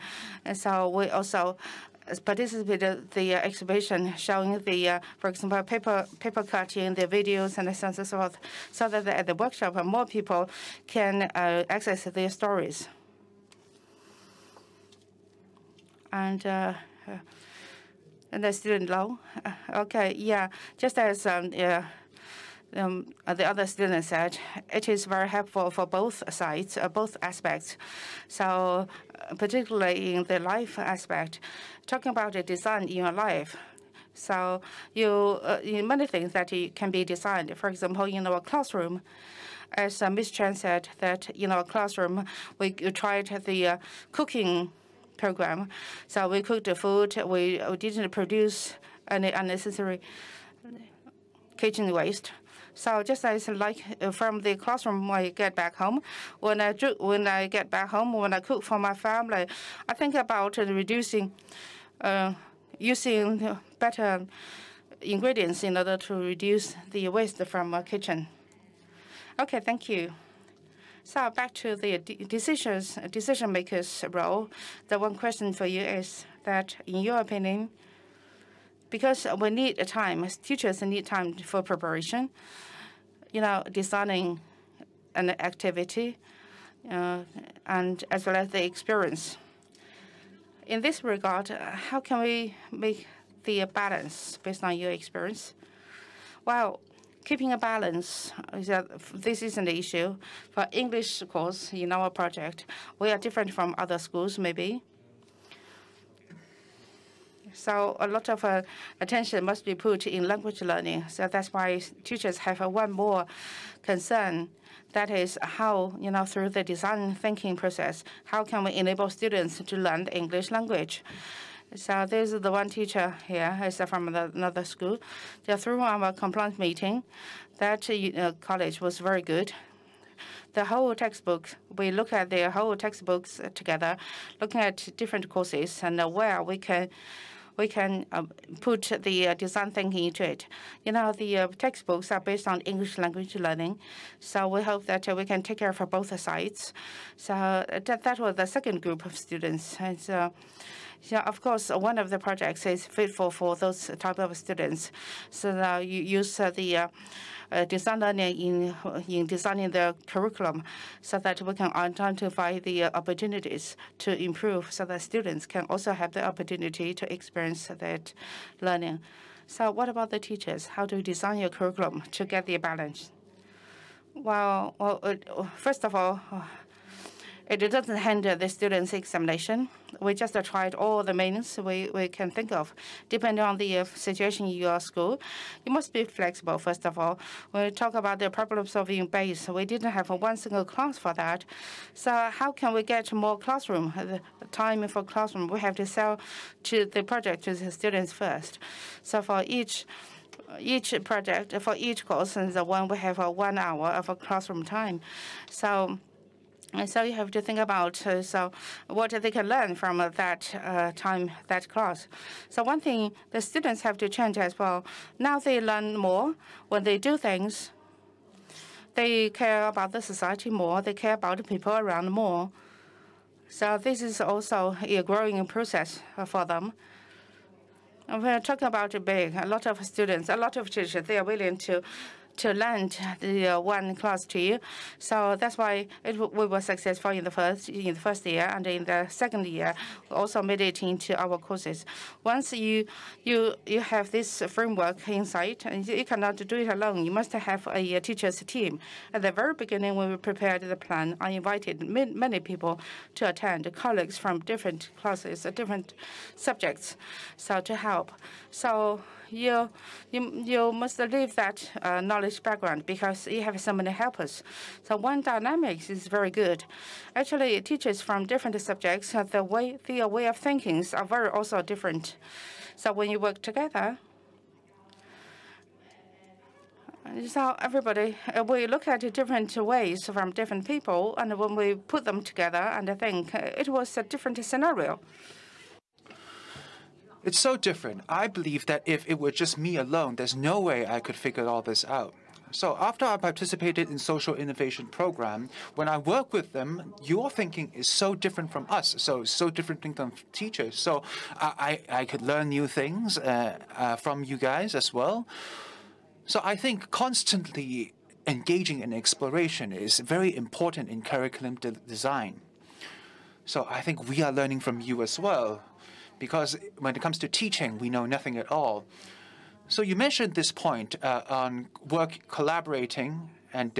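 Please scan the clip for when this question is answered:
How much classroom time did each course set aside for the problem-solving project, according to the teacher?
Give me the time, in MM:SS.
03:23.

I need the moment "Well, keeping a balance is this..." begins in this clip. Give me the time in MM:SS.
01:36.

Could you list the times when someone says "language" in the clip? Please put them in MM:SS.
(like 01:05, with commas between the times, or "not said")
01:50, 02:00, 02:22.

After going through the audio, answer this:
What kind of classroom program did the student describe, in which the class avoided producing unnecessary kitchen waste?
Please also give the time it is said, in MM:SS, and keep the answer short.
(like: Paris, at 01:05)
cooking program, at 00:44.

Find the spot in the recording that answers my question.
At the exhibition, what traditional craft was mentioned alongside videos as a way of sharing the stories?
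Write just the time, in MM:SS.
00:06.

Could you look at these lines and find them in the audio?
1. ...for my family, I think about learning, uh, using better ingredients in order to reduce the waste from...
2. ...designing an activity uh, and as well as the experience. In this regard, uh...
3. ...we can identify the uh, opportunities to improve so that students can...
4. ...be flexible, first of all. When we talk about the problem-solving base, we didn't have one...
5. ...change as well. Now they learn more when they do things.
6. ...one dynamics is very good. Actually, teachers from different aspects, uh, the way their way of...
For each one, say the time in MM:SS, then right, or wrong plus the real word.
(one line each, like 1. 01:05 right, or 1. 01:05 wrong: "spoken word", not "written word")
1. 00:58 wrong: "reducing", not "learning"
2. 01:23 right
3. 02:41 right
4. 03:05 right
5. 03:34 right
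6. 04:24 wrong: "subjects", not "aspects".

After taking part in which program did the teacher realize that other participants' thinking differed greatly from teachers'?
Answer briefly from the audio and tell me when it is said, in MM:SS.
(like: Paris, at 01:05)
social innovation program, at 04:53.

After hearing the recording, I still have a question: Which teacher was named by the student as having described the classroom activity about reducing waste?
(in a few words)
Ms. Chen.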